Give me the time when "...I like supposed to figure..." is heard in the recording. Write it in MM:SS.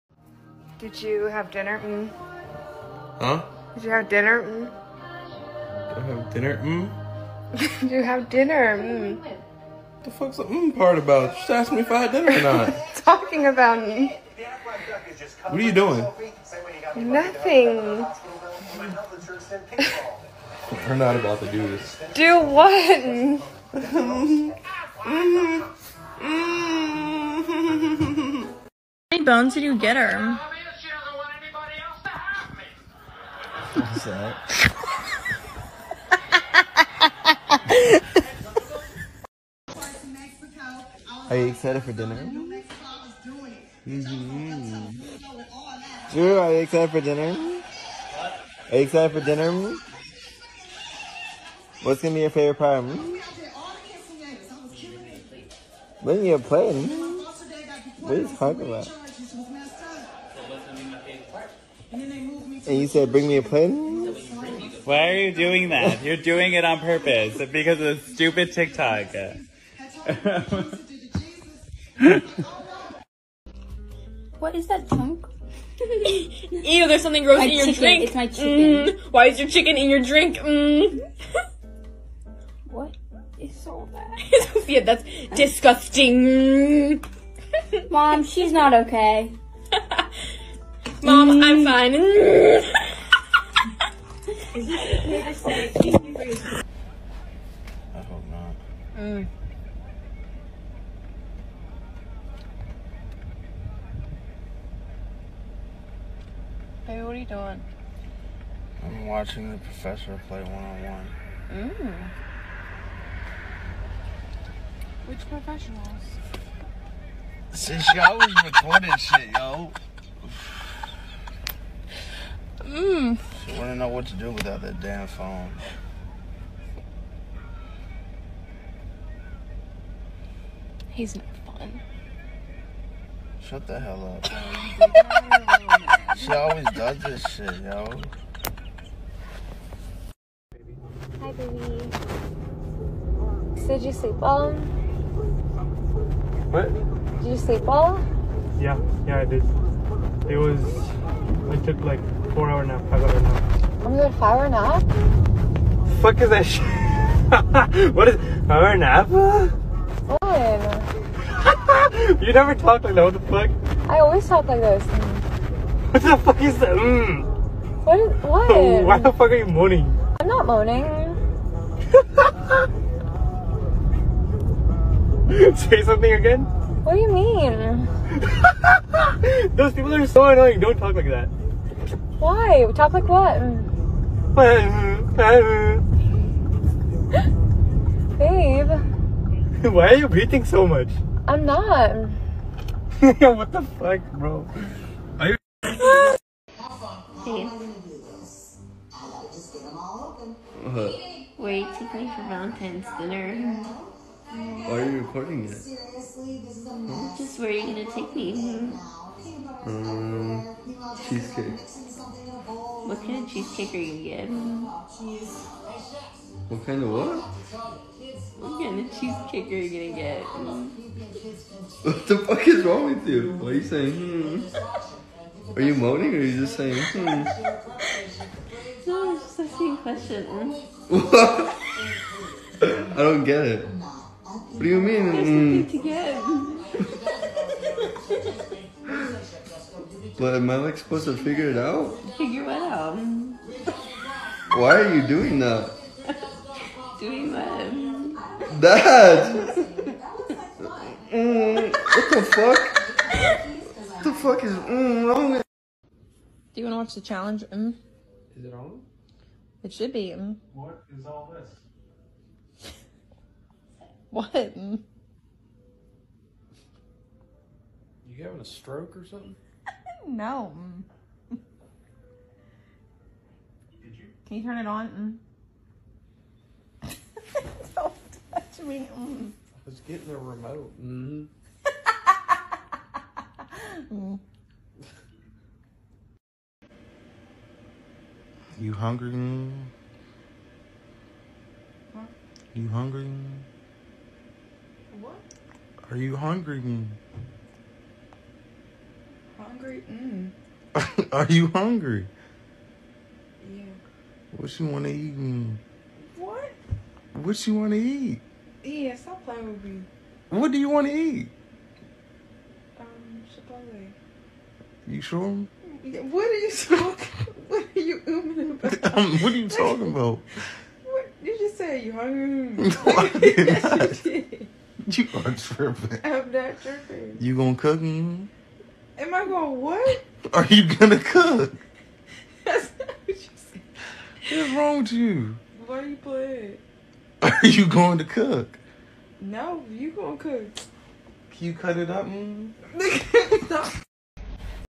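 04:00.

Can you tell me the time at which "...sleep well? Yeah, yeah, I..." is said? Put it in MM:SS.
02:27.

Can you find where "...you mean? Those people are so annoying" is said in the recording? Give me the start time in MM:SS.
02:57.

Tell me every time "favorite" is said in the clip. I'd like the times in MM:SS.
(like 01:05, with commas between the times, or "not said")
00:52.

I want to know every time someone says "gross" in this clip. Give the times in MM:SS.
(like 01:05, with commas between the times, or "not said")
01:17.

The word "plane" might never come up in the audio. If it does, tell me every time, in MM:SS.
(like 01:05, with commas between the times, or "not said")
01:03.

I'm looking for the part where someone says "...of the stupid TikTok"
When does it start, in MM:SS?
01:07.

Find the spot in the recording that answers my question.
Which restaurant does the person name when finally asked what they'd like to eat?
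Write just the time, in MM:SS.
05:12.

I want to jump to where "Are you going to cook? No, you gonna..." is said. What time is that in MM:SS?
05:37.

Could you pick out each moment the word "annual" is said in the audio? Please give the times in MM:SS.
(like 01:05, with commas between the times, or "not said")
not said.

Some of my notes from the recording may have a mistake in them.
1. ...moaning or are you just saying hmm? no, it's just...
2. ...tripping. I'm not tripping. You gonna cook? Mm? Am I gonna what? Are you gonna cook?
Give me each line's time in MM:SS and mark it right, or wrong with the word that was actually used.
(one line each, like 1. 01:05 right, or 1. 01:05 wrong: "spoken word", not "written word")
1. 03:45 right
2. 05:25 right.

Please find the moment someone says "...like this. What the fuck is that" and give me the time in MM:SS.
02:44.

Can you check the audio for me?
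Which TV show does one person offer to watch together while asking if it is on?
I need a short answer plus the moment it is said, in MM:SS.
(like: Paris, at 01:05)
The Challenge, at 04:16.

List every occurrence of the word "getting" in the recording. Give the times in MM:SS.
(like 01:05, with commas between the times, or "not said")
03:34, 04:39.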